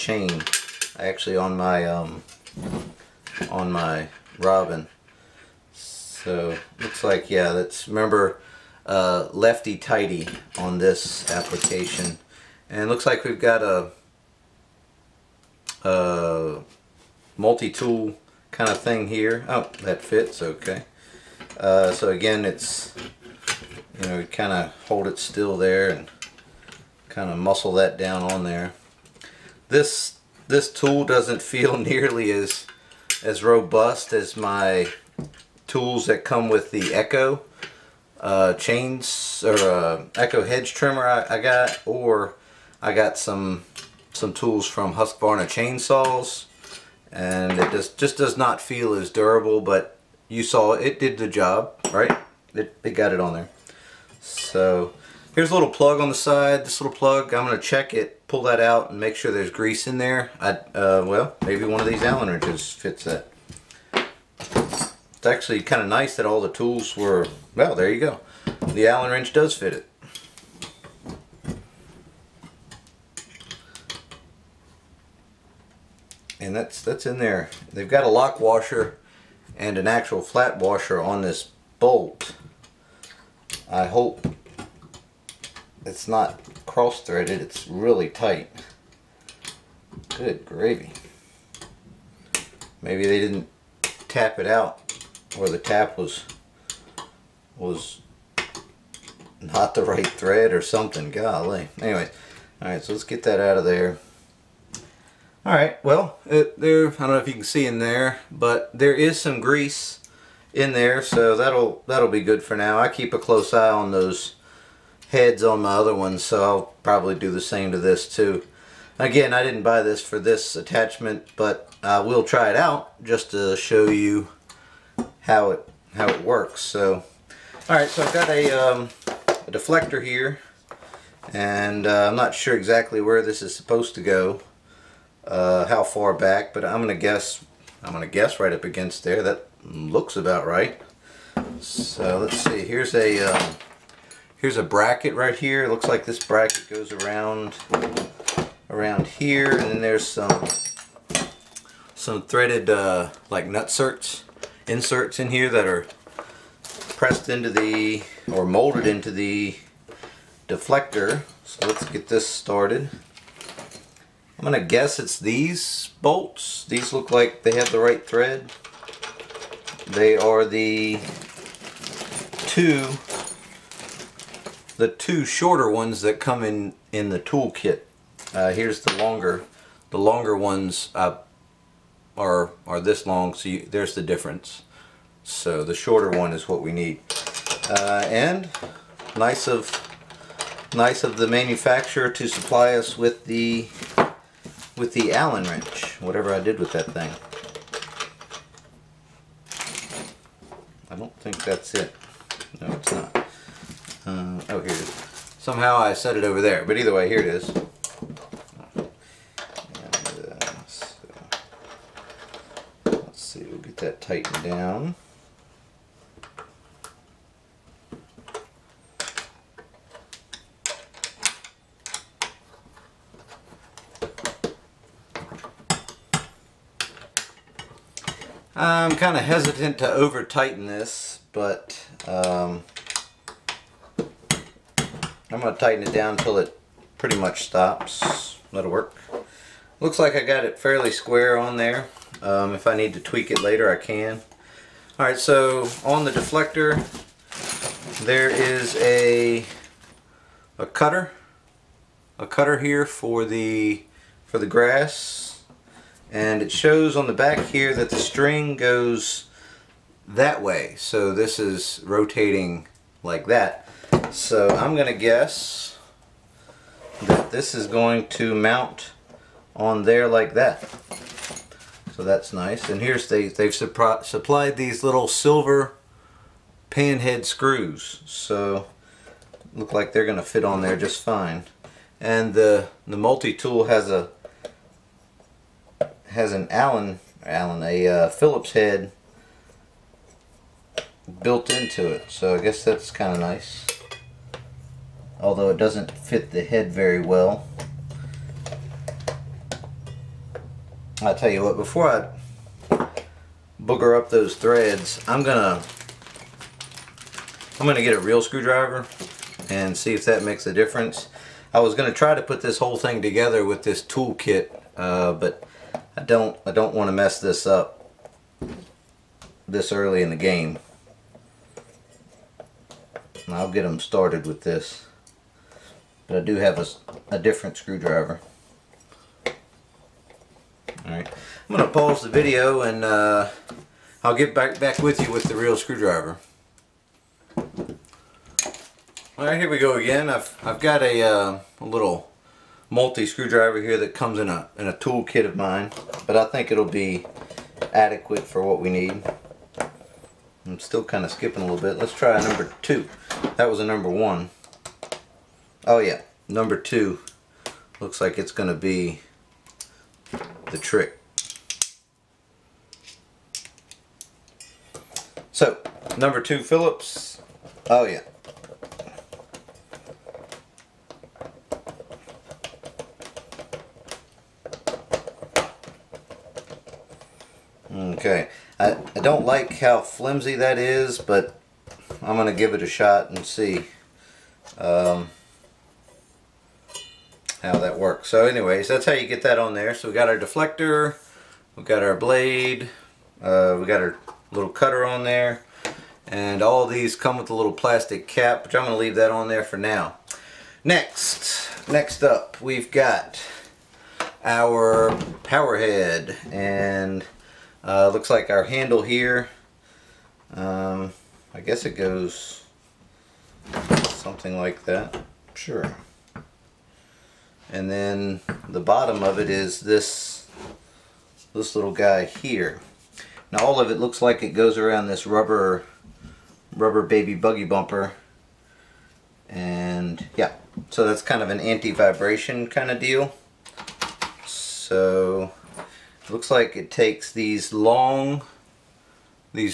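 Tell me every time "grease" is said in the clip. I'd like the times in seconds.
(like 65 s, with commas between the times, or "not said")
59 s, 109 s.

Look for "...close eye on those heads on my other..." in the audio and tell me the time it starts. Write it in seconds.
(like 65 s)
113 s.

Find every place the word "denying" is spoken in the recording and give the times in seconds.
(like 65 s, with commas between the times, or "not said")
not said.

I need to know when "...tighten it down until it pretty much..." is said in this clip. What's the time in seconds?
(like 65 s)
235 s.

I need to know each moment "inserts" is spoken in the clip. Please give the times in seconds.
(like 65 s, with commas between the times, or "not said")
154 s.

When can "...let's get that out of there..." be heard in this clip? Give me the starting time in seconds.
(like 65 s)
102 s.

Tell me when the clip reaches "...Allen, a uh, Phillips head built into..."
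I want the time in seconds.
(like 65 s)
287 s.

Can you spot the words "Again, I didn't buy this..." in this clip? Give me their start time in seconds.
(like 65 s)
118 s.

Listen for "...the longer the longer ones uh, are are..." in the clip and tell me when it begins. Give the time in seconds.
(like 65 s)
178 s.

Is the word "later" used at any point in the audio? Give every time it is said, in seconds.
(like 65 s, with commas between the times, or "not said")
243 s.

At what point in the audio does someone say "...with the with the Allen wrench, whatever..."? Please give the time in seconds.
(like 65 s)
192 s.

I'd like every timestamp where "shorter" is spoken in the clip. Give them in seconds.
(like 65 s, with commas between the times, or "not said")
175 s, 185 s.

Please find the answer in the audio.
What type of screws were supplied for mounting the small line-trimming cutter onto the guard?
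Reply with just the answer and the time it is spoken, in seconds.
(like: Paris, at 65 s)
Silver panhead screws, at 275 s.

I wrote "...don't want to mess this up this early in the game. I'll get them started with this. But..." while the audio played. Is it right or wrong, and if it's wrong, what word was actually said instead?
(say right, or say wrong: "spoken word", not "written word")
right.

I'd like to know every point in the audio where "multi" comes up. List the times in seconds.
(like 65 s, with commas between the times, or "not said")
17 s, 282 s, 342 s.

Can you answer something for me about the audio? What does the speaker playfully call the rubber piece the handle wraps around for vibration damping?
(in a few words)
Rubber baby buggy bumper.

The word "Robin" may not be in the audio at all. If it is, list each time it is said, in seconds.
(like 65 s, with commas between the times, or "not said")
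4 s.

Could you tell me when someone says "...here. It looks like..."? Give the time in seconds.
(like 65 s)
145 s.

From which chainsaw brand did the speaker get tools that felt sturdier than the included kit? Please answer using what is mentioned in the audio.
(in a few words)
Husqvarna.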